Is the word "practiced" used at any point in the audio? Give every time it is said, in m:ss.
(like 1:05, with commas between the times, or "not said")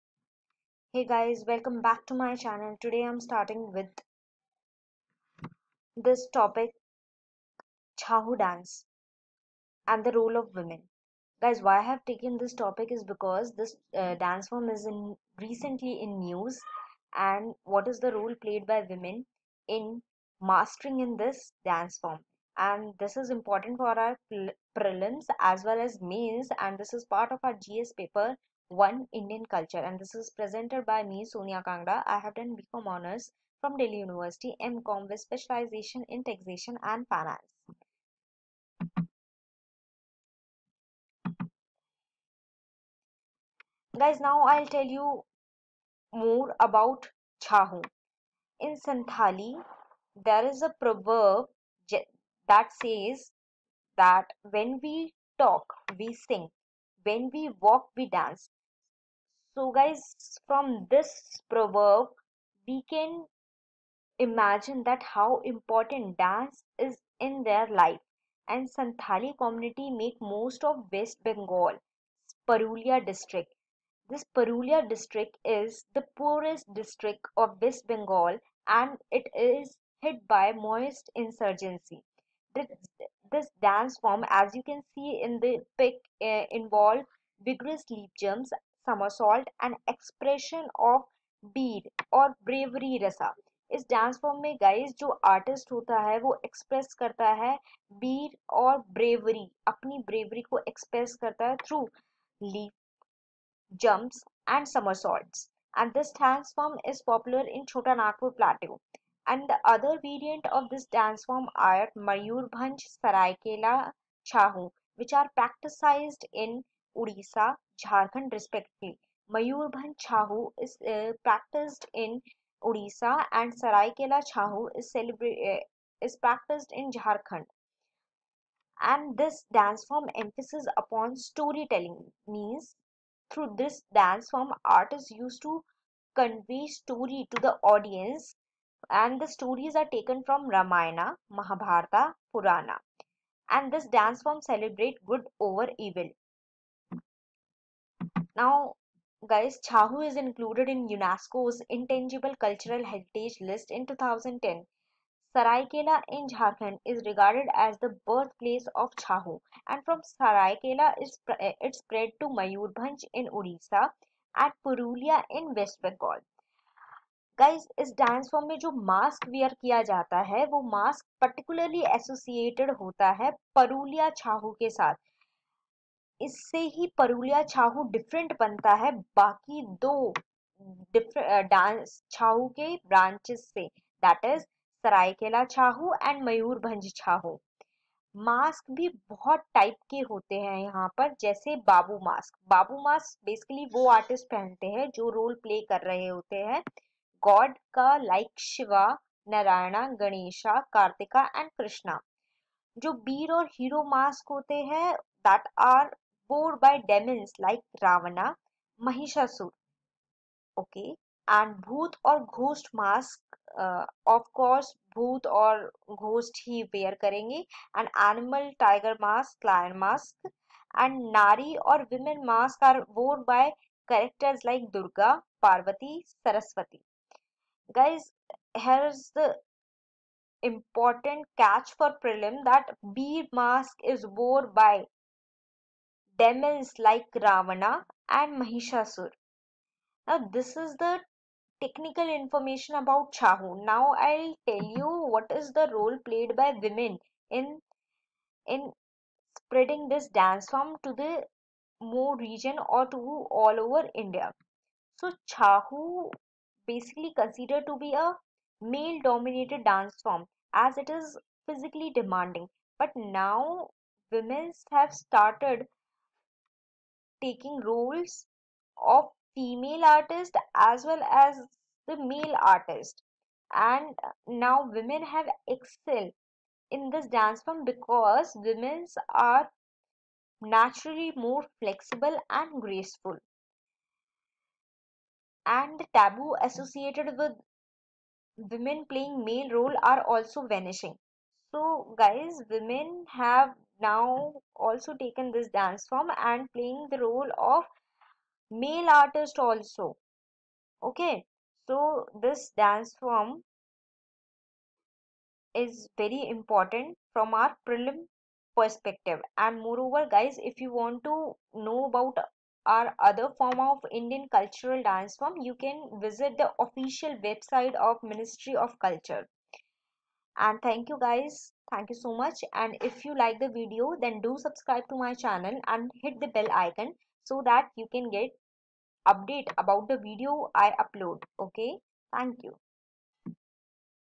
1:55, 2:01, 2:06.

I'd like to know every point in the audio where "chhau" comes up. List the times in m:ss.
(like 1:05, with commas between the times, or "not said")
0:08, 0:47, 1:59, 2:04, 4:03, 4:15.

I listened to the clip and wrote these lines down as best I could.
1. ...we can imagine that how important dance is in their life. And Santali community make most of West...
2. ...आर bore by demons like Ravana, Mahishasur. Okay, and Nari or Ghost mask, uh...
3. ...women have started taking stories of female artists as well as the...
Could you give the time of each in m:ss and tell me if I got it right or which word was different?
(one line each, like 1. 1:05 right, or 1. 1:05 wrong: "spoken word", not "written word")
1. 1:02 right
2. 3:25 wrong: "Bhoot", not "Nari"
3. 4:24 wrong: "roles", not "stories".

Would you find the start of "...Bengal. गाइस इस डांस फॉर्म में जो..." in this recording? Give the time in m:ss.
2:45.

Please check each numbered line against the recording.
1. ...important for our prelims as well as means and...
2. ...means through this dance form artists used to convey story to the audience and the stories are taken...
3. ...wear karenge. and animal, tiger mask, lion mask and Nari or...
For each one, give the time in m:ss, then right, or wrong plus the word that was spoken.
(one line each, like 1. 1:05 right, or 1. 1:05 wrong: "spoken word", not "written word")
1. 0:23 wrong: "mains", not "means"
2. 2:12 right
3. 3:36 right.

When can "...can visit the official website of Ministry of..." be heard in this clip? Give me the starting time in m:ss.
5:15.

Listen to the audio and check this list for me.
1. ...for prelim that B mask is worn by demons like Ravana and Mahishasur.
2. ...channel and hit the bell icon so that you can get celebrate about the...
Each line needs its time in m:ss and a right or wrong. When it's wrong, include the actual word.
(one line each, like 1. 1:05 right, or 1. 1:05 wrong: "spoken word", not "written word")
1. 3:51 right
2. 5:25 wrong: "update", not "celebrate".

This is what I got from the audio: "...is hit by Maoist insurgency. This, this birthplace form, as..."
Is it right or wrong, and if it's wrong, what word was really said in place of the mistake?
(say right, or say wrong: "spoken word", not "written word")
wrong: "dance", not "birthplace".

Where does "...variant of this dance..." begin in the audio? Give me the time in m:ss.
1:50.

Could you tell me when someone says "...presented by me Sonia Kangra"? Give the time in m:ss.
0:30.